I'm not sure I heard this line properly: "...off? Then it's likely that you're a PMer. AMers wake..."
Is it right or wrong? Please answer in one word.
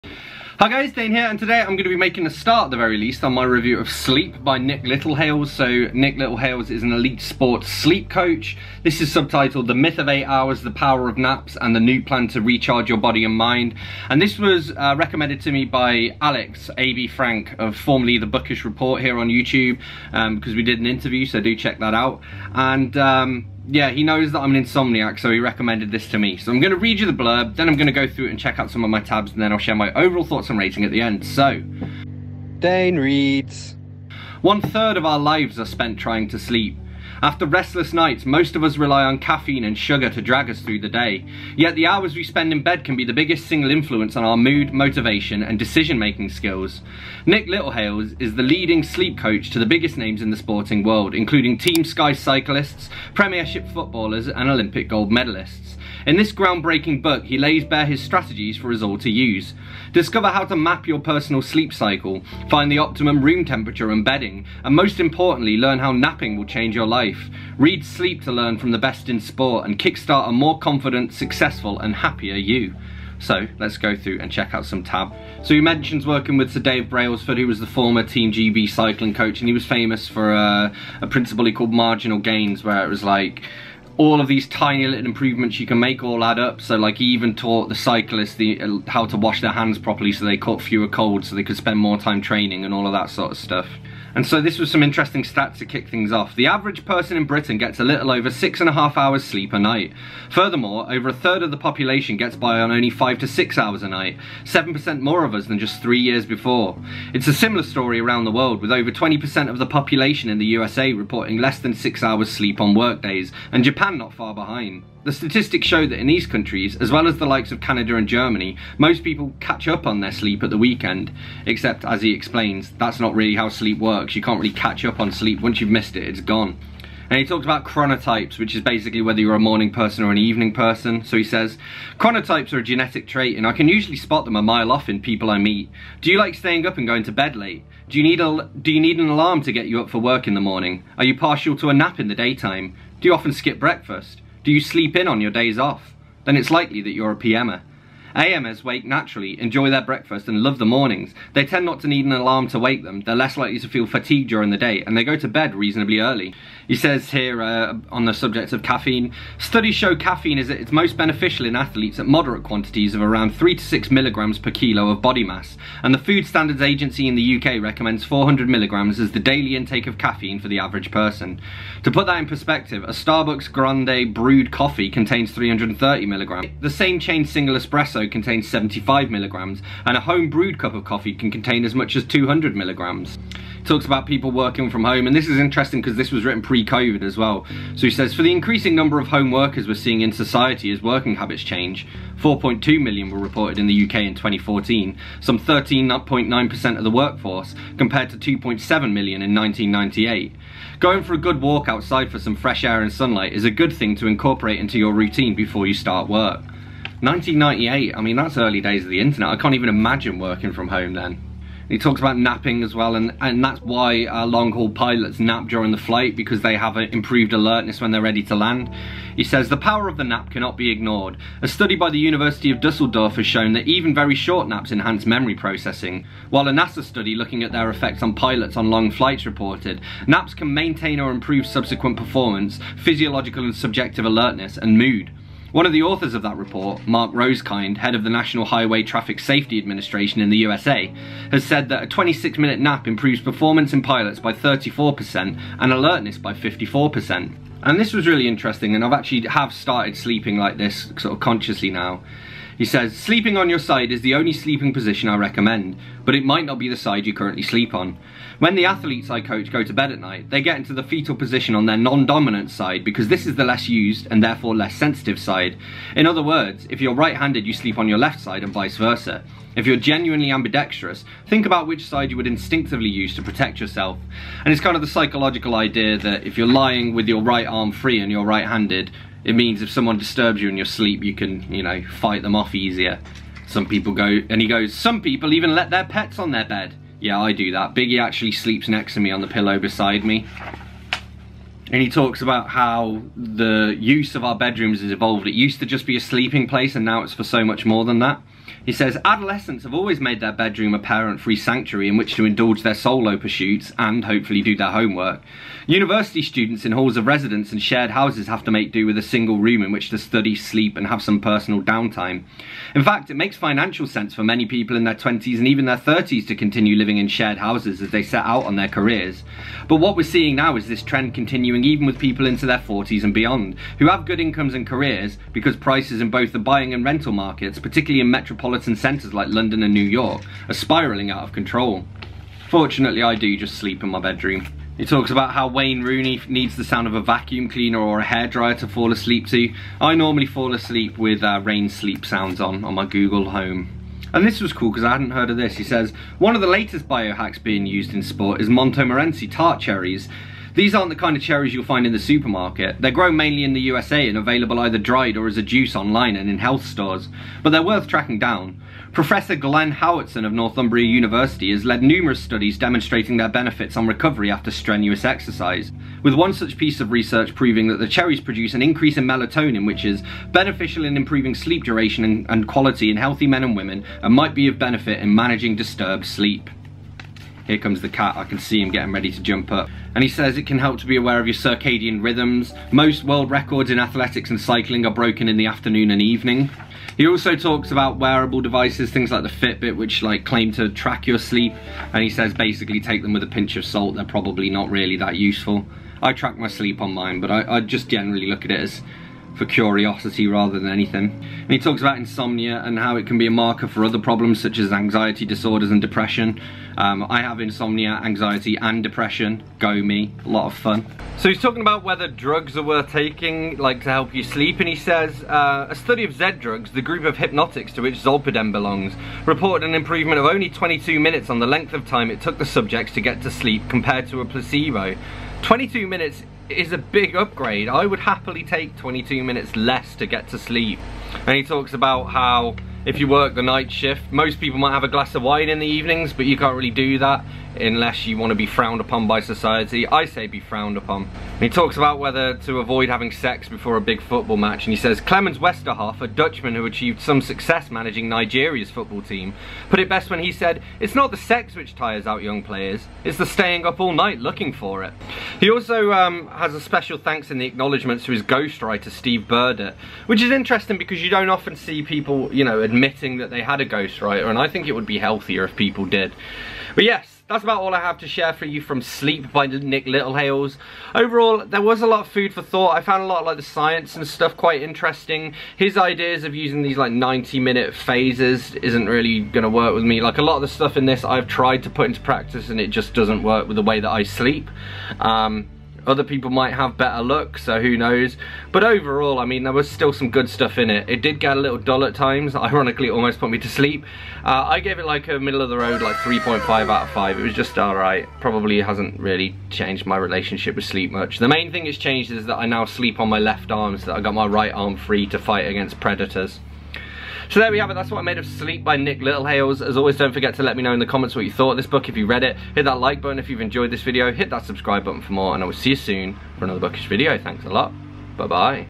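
right.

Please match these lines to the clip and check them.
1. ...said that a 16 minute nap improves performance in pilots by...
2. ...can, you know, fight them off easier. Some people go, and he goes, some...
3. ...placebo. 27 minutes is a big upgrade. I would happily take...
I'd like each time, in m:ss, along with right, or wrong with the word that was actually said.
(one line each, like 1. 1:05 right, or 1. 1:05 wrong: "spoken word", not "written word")
1. 4:01 wrong: "26", not "16"
2. 4:41 right
3. 7:04 wrong: "22", not "27".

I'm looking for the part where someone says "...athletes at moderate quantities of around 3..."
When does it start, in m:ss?
2:41.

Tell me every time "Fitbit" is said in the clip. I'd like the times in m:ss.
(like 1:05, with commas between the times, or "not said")
6:29.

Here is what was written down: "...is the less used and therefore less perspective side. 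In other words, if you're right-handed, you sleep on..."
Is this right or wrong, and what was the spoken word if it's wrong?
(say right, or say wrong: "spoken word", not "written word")
wrong: "sensitive", not "perspective".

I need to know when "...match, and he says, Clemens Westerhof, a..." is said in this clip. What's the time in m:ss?
7:24.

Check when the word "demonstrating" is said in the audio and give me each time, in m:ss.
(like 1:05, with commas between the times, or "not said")
6:02.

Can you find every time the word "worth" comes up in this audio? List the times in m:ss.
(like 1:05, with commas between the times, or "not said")
5:57, 6:52.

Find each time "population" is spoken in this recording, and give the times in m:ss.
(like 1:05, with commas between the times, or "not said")
1:41, 1:49.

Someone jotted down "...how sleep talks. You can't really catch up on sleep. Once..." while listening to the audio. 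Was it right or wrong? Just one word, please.
wrong.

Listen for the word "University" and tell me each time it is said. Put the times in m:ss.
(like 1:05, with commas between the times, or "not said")
3:41, 5:05, 6:00.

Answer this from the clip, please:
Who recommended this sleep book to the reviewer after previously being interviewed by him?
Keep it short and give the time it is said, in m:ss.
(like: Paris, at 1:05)
Alex A.B. Frank, at 0:16.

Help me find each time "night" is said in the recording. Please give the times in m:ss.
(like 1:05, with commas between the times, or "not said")
0:37, 1:39, 1:43, 4:19, 7:13, 7:33.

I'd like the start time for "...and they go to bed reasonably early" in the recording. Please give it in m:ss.
2:34.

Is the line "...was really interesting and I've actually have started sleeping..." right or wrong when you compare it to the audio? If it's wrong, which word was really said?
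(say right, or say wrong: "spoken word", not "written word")
right.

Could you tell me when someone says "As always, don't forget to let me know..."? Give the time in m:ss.
8:29.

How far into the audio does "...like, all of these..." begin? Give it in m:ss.
1:23.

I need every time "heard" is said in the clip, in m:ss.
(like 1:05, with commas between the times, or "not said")
5:45.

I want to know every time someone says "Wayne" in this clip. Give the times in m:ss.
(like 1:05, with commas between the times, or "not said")
5:35.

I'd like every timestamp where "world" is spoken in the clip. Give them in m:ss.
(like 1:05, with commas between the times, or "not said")
0:50, 1:48, 6:23.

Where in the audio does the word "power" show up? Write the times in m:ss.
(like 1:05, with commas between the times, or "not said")
0:10, 3:39.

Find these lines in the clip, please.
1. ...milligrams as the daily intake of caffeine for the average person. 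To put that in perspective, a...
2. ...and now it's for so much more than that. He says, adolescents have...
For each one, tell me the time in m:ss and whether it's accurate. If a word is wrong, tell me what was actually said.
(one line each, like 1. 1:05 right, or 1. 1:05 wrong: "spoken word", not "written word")
1. 2:48 right
2. 4:56 right.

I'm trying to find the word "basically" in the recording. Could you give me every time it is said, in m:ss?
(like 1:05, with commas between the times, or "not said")
2:08, 6:32.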